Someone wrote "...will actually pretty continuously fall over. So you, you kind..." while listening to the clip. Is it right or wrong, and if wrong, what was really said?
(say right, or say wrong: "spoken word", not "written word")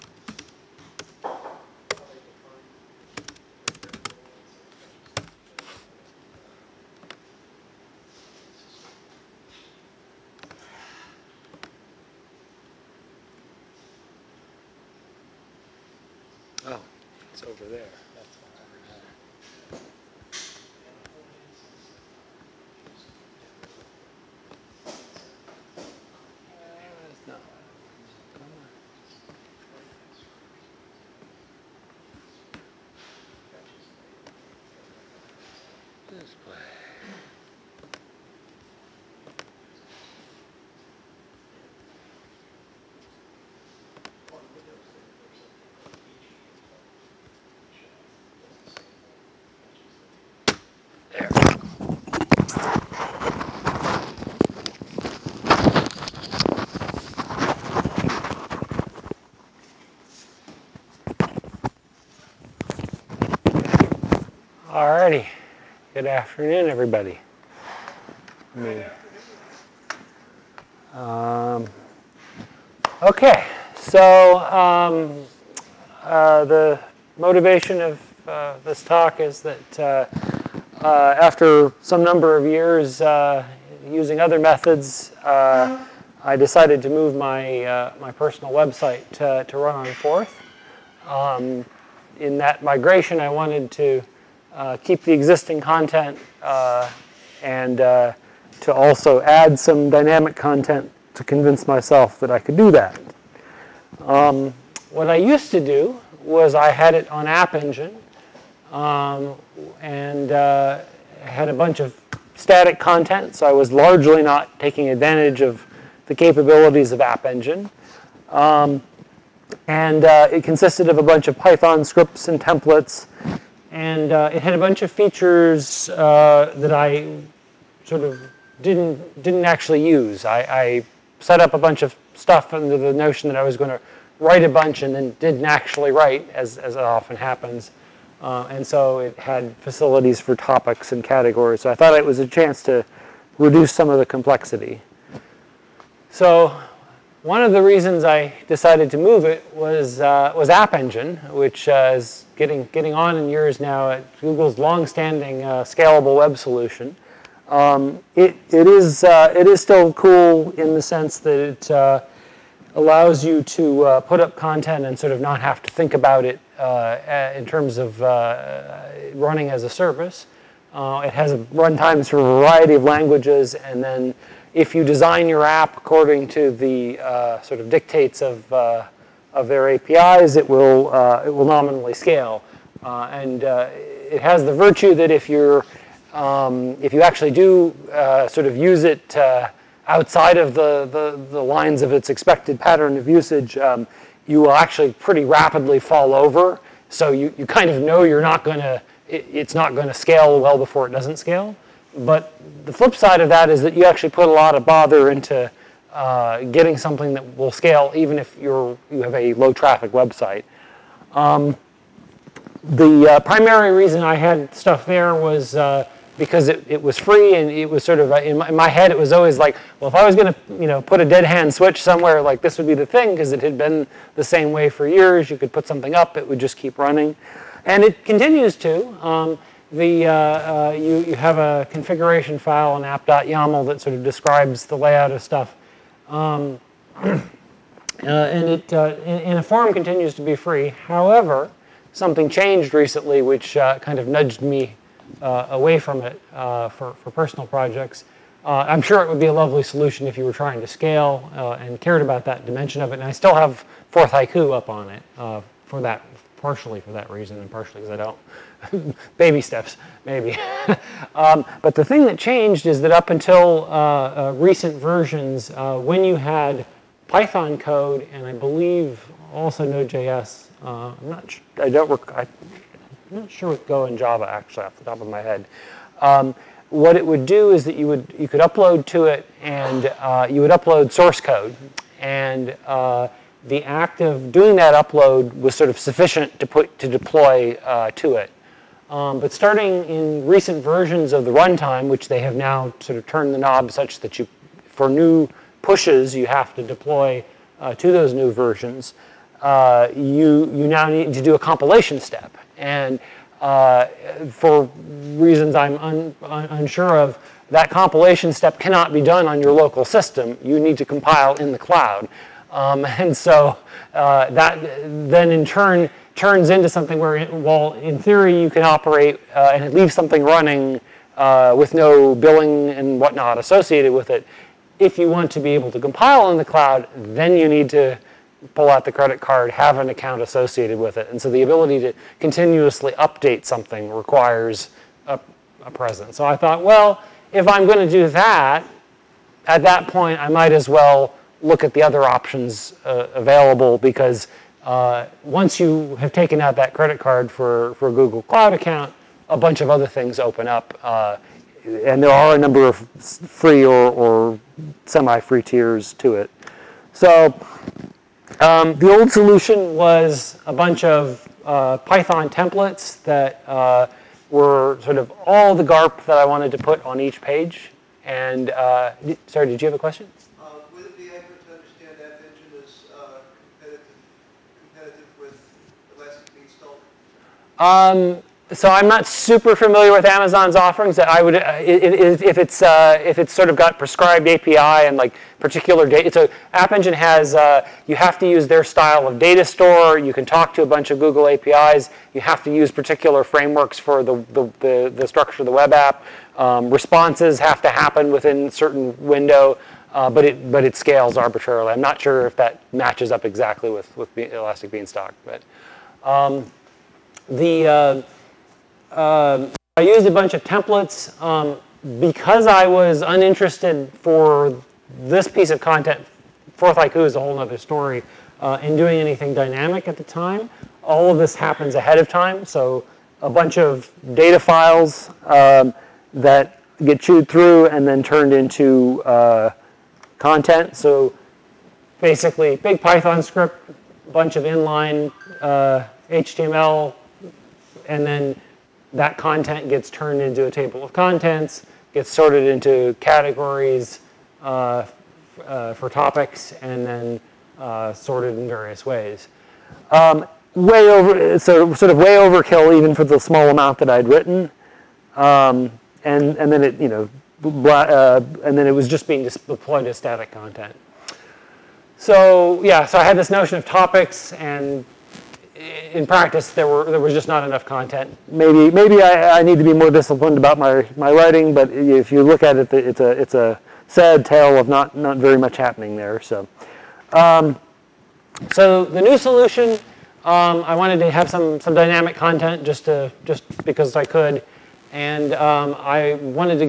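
wrong: "rapidly", not "continuously".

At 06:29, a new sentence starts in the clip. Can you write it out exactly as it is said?
You can talk to a bunch of Google APIs.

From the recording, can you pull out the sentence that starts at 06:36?
Um, responses have to happen within a certain window, uh, but it but it scales arbitrarily.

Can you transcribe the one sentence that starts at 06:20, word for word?
I would, uh, if it's uh, if it's sort of got prescribed API and like particular data.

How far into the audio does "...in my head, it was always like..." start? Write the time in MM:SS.
03:38.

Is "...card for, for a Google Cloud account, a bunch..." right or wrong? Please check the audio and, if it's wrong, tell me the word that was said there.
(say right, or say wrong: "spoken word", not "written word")
right.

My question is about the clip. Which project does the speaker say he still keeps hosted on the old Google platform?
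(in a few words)
Forth Haiku.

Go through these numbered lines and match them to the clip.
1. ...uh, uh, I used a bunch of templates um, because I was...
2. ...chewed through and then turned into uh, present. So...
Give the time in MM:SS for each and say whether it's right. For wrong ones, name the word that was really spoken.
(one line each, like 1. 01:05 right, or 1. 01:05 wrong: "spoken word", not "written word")
1. 06:48 right
2. 07:07 wrong: "content", not "present".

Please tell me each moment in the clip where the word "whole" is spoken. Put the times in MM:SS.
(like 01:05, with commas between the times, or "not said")
06:57.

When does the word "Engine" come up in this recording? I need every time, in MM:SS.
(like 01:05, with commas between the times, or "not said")
01:47, 01:57, 02:30, 06:26.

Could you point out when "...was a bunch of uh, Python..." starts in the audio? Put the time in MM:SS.
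05:59.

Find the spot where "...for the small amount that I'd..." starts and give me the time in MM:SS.
07:32.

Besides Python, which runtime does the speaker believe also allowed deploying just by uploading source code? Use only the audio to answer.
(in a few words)
Node.js.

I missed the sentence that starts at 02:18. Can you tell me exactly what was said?
Uh, and so it had facilities for topics and categories.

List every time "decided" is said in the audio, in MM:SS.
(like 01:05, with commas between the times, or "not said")
01:26, 02:28.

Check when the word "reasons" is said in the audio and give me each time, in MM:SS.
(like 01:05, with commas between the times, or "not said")
02:27, 03:33, 04:17, 05:05.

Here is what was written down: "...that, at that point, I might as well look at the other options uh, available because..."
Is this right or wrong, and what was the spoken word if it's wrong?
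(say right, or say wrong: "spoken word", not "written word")
right.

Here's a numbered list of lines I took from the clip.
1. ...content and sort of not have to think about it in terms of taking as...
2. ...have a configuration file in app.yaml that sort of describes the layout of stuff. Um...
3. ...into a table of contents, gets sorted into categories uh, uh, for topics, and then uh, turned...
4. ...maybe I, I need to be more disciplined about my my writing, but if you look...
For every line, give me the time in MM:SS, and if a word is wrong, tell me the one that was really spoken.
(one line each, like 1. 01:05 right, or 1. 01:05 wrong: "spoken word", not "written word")
1. 02:44 wrong: "running", not "taking"
2. 03:51 right
3. 07:20 wrong: "sorted", not "turned"
4. 07:48 right.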